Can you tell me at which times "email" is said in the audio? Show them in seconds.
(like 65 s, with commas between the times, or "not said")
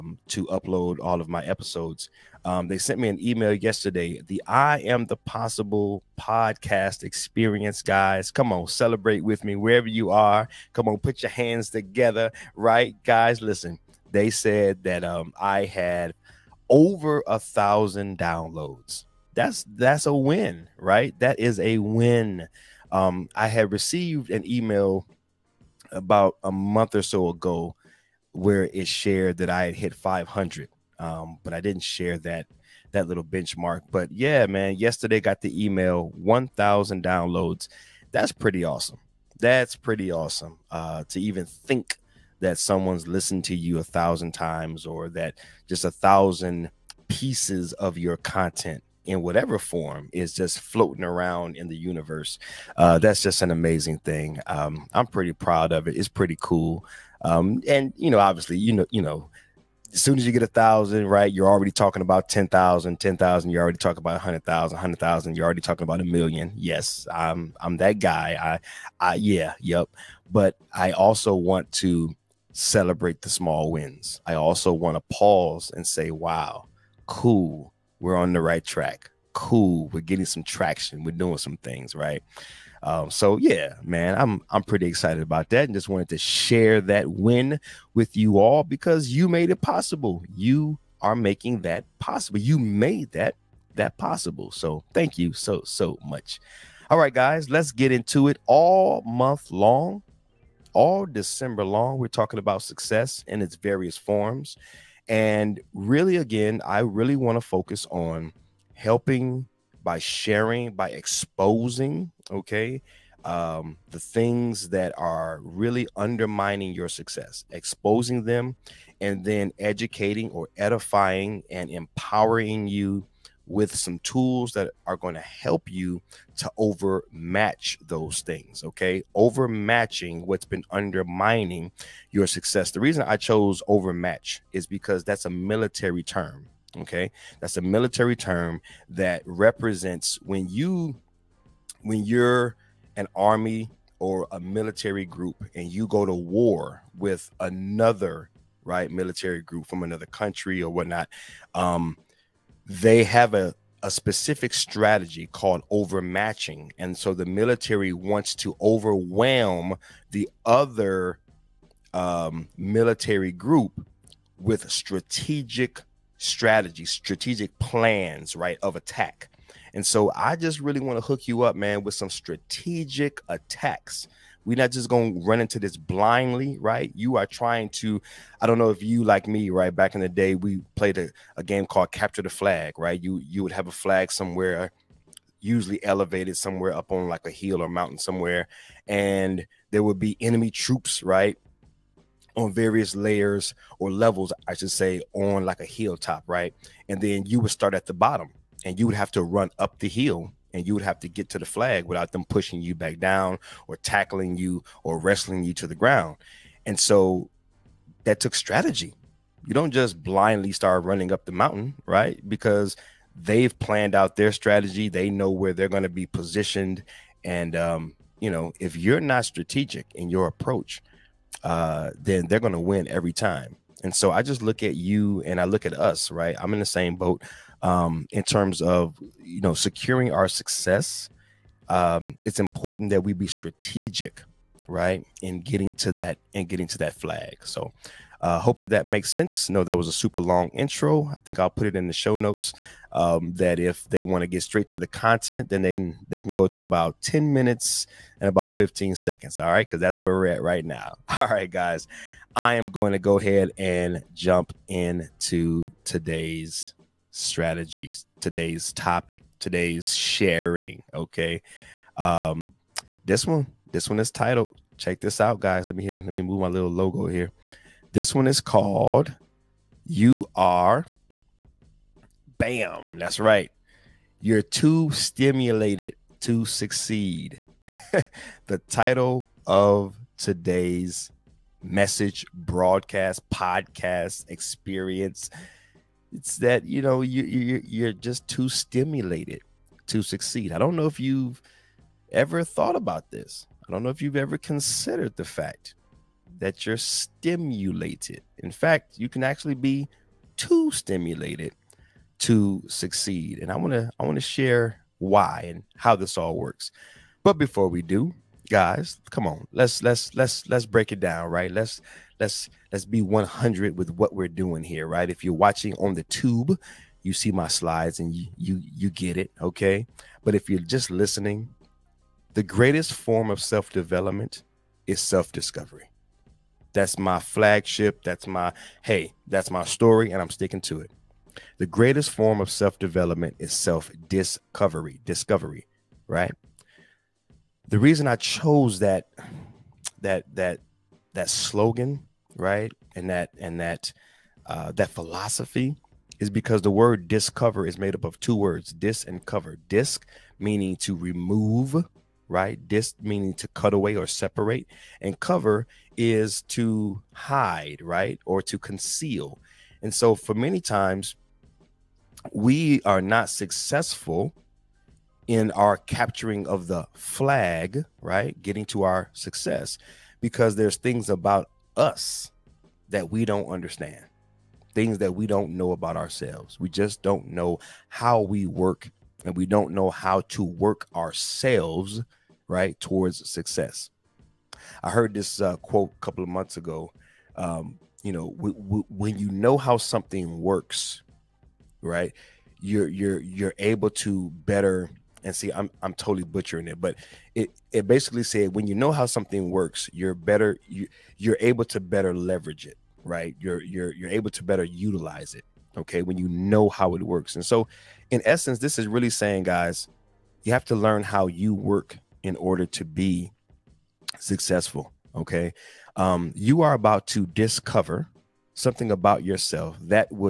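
3 s, 24 s, 35 s.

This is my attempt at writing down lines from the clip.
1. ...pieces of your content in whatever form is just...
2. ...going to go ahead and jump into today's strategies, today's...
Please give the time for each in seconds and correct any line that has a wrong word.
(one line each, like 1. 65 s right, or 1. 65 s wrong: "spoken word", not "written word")
1. 47 s right
2. 252 s right.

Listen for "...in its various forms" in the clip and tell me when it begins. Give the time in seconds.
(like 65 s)
103 s.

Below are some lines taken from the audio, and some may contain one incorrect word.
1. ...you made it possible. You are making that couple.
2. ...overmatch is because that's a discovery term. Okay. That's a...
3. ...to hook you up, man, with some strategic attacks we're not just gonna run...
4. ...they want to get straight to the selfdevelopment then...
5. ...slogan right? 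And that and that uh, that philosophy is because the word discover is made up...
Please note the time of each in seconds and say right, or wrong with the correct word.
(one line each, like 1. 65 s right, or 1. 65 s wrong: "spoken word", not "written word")
1. 89 s wrong: "possible", not "couple"
2. 133 s wrong: "military", not "discovery"
3. 170 s right
4. 243 s wrong: "content", not "selfdevelopment"
5. 341 s right.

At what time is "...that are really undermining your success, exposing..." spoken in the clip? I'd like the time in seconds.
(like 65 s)
114 s.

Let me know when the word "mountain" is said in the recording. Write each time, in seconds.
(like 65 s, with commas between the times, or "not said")
187 s, 211 s.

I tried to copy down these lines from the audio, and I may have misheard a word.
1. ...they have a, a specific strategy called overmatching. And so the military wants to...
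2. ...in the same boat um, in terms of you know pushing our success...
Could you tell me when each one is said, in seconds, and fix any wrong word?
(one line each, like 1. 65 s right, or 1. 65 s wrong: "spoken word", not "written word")
1. 152 s right
2. 226 s wrong: "securing", not "pushing".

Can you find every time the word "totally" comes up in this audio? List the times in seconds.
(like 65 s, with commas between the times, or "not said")
395 s.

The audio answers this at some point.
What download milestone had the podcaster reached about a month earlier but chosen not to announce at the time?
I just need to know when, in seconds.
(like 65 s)
29 s.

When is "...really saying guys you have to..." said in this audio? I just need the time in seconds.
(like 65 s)
408 s.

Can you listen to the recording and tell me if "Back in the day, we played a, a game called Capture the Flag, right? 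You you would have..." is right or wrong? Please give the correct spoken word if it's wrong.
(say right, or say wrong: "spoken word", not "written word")
right.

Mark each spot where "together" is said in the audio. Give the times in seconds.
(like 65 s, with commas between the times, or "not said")
11 s.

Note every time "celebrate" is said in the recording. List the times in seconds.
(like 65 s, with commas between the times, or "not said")
8 s, 72 s.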